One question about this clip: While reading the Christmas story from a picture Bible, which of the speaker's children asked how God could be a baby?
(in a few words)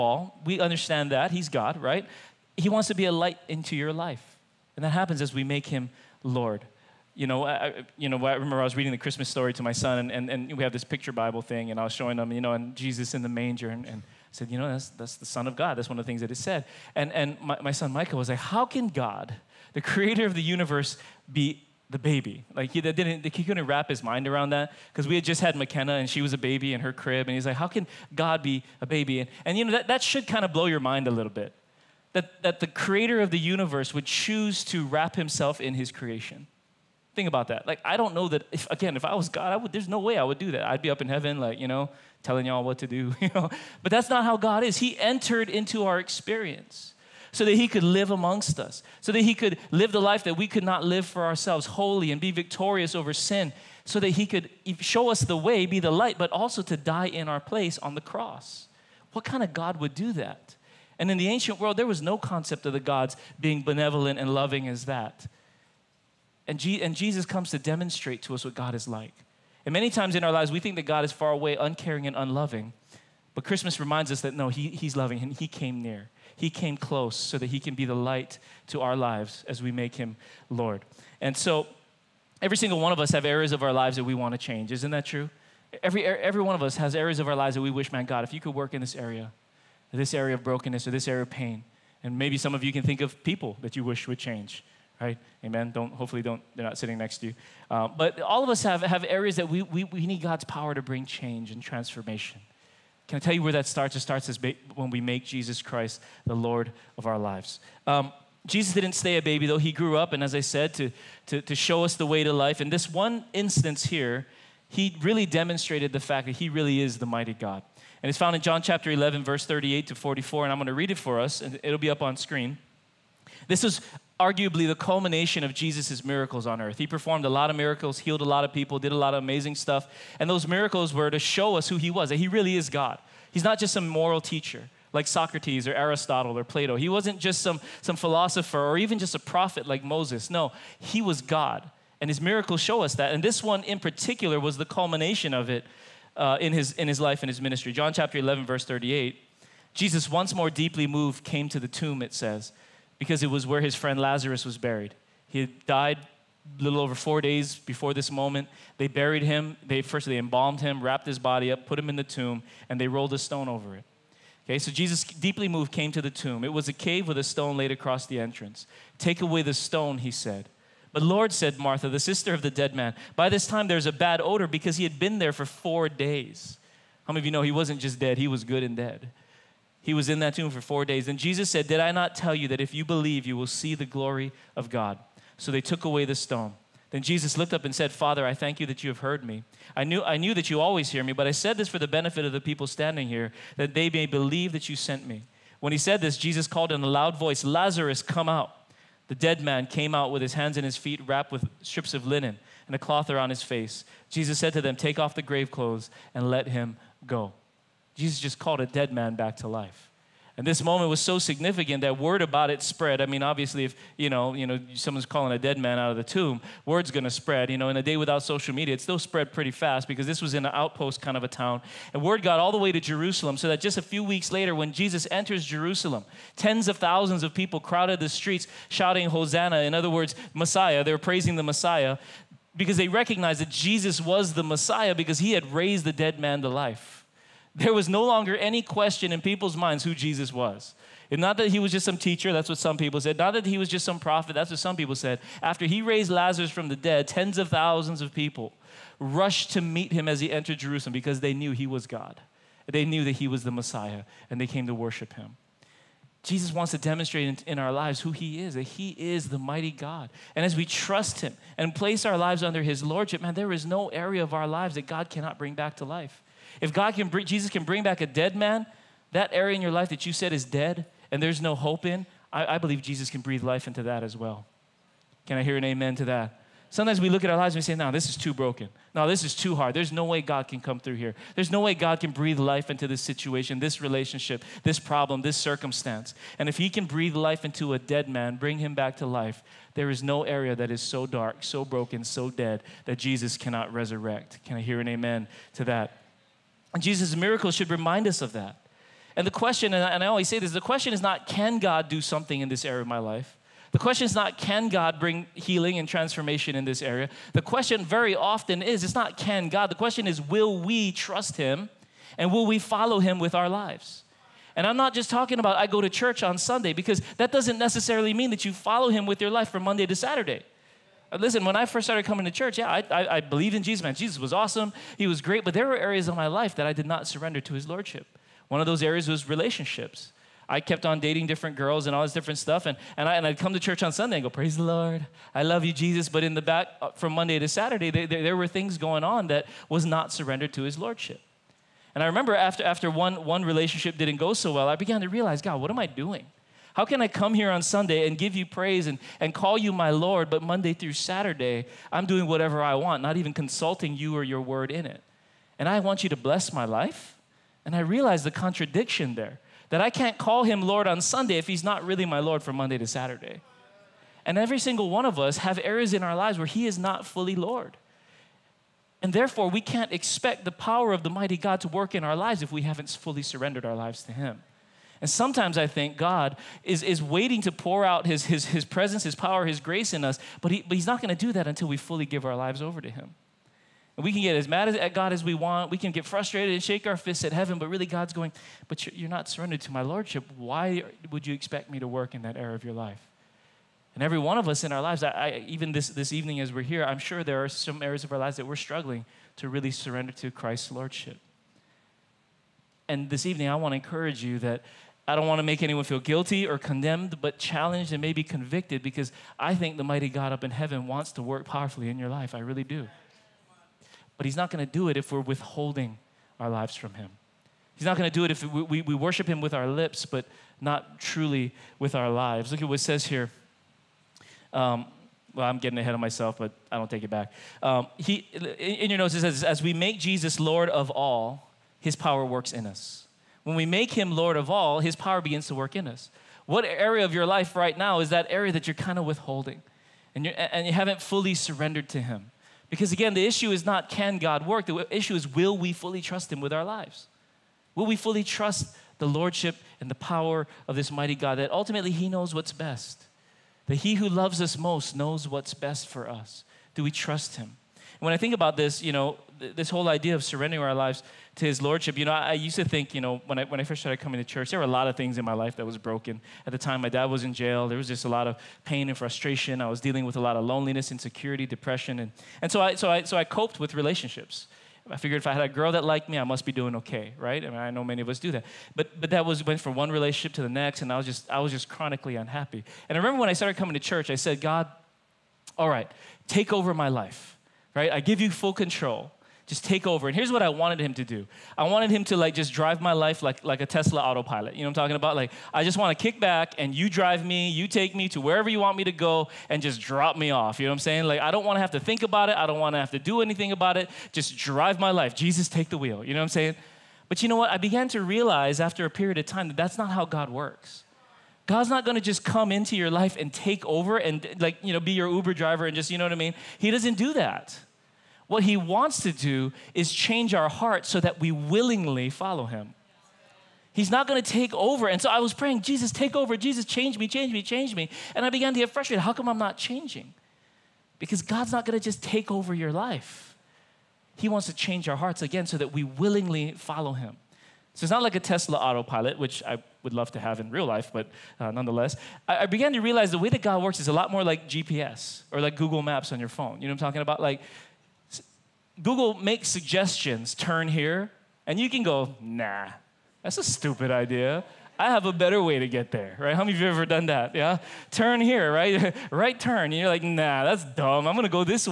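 Michael.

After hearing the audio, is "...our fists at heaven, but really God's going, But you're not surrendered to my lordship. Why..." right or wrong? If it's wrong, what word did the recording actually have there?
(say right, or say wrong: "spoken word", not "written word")
right.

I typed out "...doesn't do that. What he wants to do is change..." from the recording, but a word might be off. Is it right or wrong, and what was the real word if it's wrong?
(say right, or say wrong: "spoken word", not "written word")
right.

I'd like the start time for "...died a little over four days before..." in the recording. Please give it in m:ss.
2:35.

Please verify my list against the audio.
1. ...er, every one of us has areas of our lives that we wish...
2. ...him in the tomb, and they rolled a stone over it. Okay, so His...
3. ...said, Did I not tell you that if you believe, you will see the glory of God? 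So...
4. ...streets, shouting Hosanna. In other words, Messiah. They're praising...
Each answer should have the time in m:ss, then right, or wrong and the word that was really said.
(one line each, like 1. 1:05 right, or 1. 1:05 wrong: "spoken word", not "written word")
1. 1:26 right
2. 2:41 wrong: "Jesus", not "His"
3. 3:01 right
4. 3:48 right.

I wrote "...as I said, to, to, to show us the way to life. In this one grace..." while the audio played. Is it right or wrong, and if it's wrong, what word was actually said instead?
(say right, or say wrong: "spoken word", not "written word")
wrong: "instance", not "grace".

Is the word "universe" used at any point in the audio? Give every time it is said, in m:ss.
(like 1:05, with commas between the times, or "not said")
0:20, 0:33.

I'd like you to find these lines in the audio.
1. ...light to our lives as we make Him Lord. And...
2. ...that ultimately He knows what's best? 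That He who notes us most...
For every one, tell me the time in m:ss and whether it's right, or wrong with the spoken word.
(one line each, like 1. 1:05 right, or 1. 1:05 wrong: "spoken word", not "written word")
1. 1:17 right
2. 7:31 wrong: "loves", not "notes".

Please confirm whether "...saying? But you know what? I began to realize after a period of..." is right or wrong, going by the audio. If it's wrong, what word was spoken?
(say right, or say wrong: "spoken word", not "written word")
right.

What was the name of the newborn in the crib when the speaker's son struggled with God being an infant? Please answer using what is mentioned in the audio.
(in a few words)
McKenna.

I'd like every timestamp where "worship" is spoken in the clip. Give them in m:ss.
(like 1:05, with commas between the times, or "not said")
4:14, 6:58.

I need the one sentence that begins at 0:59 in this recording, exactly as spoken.
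What kind of God would do that?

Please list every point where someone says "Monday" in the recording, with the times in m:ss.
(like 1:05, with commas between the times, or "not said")
5:19, 5:37, 5:50, 6:02.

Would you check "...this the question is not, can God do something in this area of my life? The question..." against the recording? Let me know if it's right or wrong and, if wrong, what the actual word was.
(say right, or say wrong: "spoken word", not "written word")
right.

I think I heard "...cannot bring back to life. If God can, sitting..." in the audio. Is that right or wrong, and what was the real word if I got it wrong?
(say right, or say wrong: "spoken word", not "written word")
wrong: "bring", not "sitting".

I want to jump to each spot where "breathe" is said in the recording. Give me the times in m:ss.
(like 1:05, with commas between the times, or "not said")
4:33, 4:42, 4:46.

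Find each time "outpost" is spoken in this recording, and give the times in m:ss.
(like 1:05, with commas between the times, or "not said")
3:40.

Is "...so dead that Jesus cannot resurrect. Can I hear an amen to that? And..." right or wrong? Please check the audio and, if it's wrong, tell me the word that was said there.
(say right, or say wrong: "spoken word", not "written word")
right.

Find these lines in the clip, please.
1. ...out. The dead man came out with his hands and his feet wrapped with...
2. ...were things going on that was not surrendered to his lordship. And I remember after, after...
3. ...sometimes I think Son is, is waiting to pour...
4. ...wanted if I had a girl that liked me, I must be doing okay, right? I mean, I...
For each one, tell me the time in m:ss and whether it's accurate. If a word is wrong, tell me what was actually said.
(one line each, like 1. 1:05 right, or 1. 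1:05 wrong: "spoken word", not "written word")
1. 3:18 right
2. 5:38 right
3. 6:15 wrong: "God", not "Son"
4. 7:54 wrong: "figured", not "wanted".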